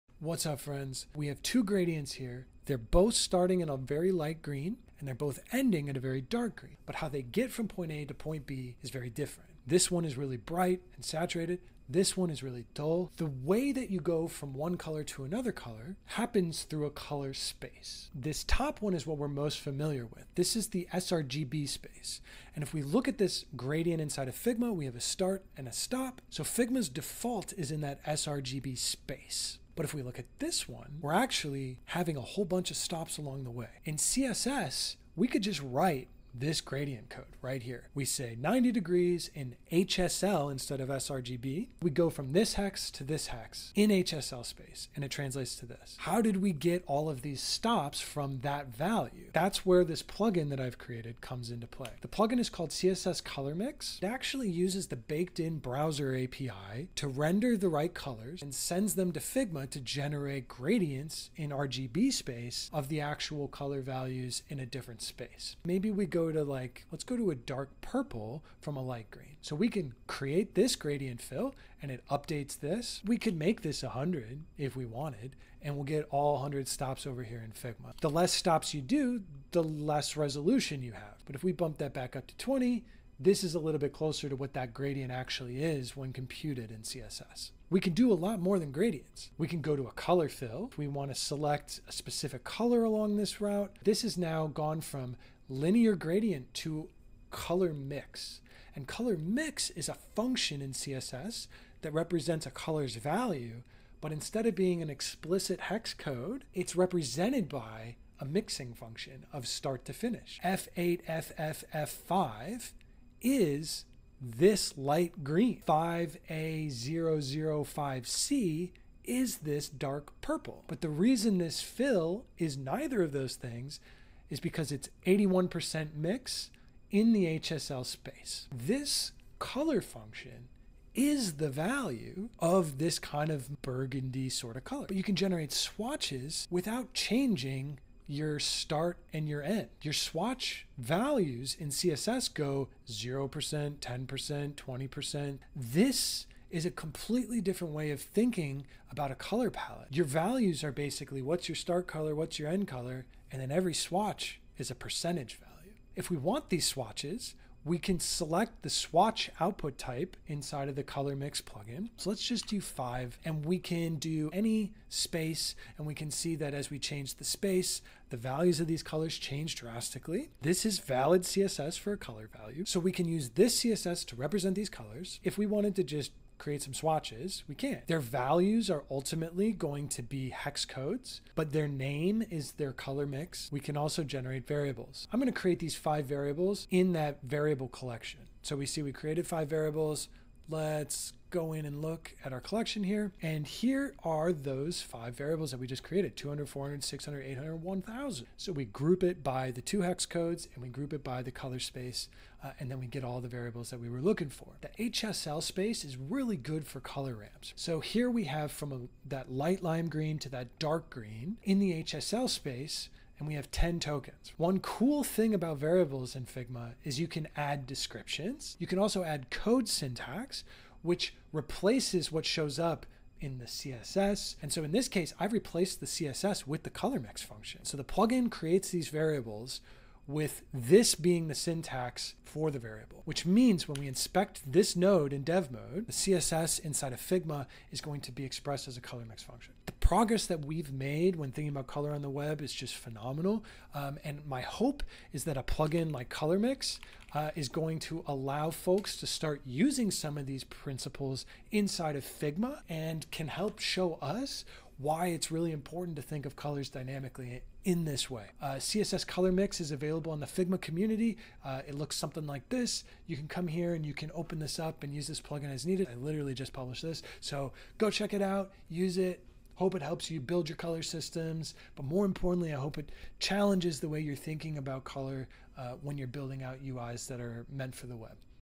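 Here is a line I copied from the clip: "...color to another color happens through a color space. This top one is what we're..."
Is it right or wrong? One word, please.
right.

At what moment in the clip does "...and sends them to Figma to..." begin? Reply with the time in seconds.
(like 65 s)
58 s.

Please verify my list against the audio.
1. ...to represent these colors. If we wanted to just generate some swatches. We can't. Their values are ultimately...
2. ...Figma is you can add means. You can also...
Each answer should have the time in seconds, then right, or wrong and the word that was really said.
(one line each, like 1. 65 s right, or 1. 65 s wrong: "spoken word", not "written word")
1. 174 s wrong: "create", not "generate"
2. 216 s wrong: "descriptions", not "means".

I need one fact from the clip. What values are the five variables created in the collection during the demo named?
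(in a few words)
200, 400, 600, 800, 1000.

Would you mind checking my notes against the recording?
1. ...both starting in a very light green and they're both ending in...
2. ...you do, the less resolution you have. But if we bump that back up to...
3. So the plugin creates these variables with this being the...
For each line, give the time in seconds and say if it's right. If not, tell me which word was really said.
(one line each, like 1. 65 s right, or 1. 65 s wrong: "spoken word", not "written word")
1. 2 s right
2. 78 s right
3. 227 s right.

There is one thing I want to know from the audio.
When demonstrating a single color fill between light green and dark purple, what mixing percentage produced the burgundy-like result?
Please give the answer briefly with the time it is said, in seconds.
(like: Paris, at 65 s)
81%, at 125 s.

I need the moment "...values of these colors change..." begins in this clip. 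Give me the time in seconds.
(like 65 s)
168 s.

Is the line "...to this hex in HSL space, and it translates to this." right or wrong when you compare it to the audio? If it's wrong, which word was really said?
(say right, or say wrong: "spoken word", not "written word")
right.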